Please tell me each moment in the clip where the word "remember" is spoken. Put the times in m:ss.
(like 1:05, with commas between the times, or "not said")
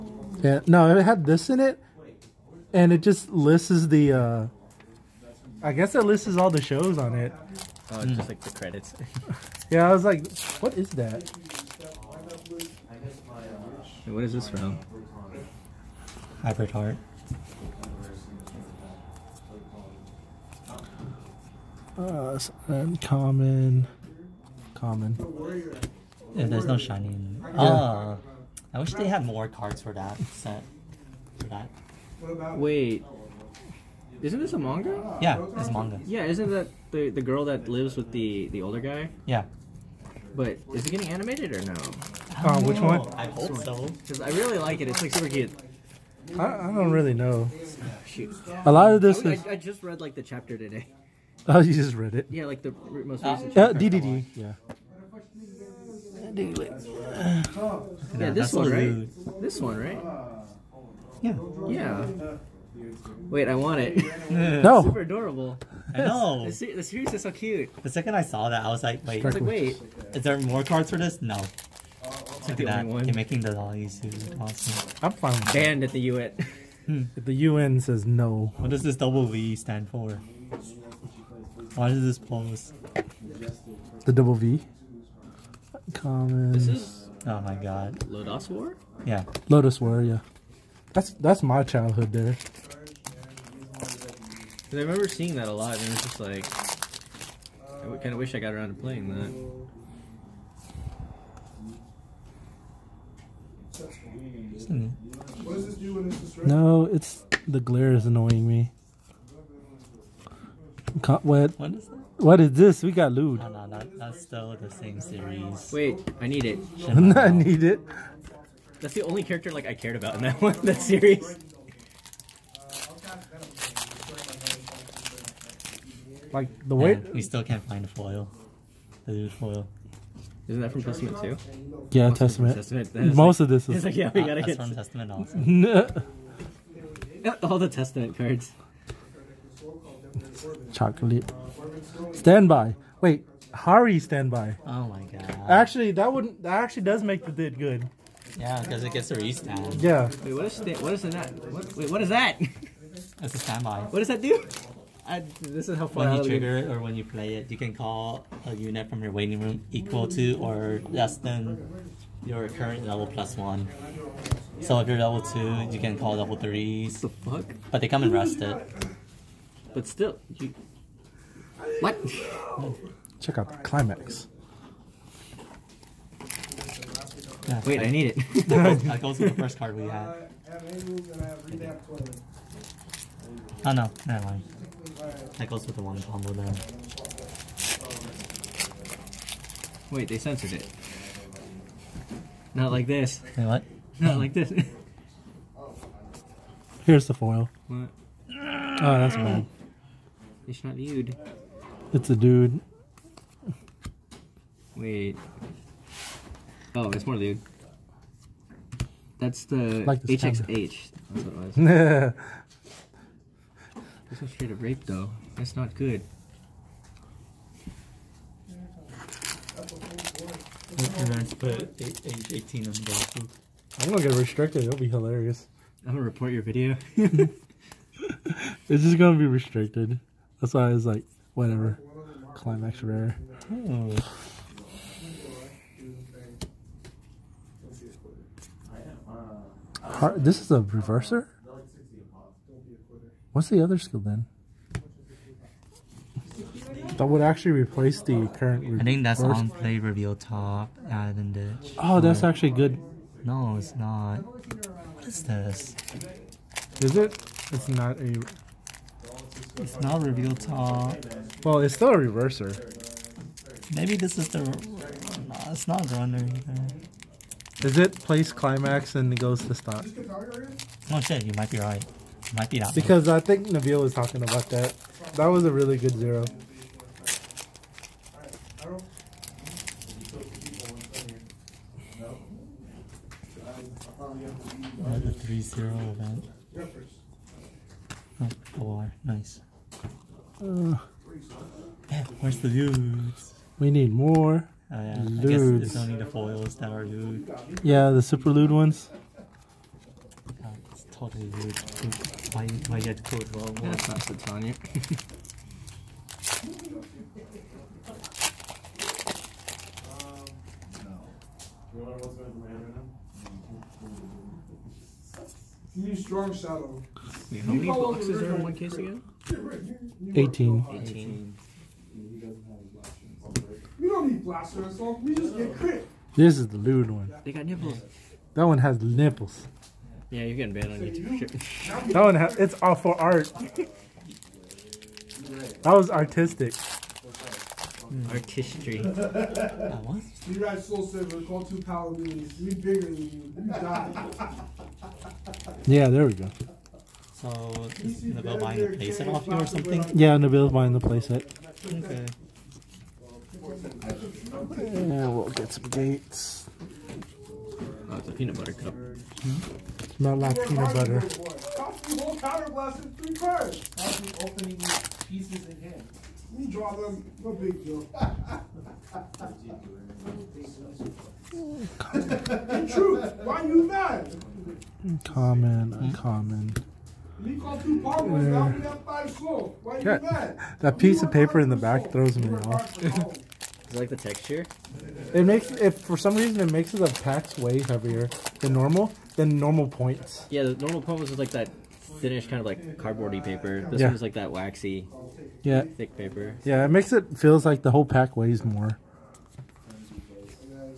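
1:34.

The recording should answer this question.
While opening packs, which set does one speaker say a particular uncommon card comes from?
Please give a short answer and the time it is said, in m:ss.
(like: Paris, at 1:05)
Hybrid Heart, at 0:16.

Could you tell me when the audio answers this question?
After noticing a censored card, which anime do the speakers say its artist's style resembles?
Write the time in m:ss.
3:30.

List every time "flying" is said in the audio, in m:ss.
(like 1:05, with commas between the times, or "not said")
not said.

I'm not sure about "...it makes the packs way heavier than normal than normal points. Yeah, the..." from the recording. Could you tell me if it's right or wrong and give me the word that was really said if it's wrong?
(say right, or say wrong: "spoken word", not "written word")
right.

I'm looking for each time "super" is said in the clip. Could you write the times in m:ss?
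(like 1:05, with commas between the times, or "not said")
0:45, 1:04, 4:58.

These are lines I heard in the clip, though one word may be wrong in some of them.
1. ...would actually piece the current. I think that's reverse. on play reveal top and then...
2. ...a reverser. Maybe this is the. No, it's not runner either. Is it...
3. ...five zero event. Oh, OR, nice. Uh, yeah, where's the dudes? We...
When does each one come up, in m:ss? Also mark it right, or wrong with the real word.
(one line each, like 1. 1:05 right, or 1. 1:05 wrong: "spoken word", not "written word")
1. 4:07 wrong: "replace", not "piece"
2. 4:21 right
3. 4:45 wrong: "three", not "five".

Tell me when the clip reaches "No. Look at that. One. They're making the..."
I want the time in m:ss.
1:11.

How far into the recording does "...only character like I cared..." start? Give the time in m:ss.
1:59.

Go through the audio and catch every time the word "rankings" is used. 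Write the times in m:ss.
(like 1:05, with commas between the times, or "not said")
not said.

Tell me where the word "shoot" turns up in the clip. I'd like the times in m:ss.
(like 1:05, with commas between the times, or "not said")
0:48.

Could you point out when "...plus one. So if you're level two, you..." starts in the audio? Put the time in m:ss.
2:43.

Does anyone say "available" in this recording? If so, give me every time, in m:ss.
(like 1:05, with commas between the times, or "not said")
not said.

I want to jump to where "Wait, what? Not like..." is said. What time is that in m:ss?
3:13.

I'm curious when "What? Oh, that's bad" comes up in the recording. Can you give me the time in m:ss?
3:17.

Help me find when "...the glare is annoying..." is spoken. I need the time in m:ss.
1:47.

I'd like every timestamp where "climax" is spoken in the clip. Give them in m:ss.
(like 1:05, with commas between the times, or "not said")
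2:53, 3:52, 4:28.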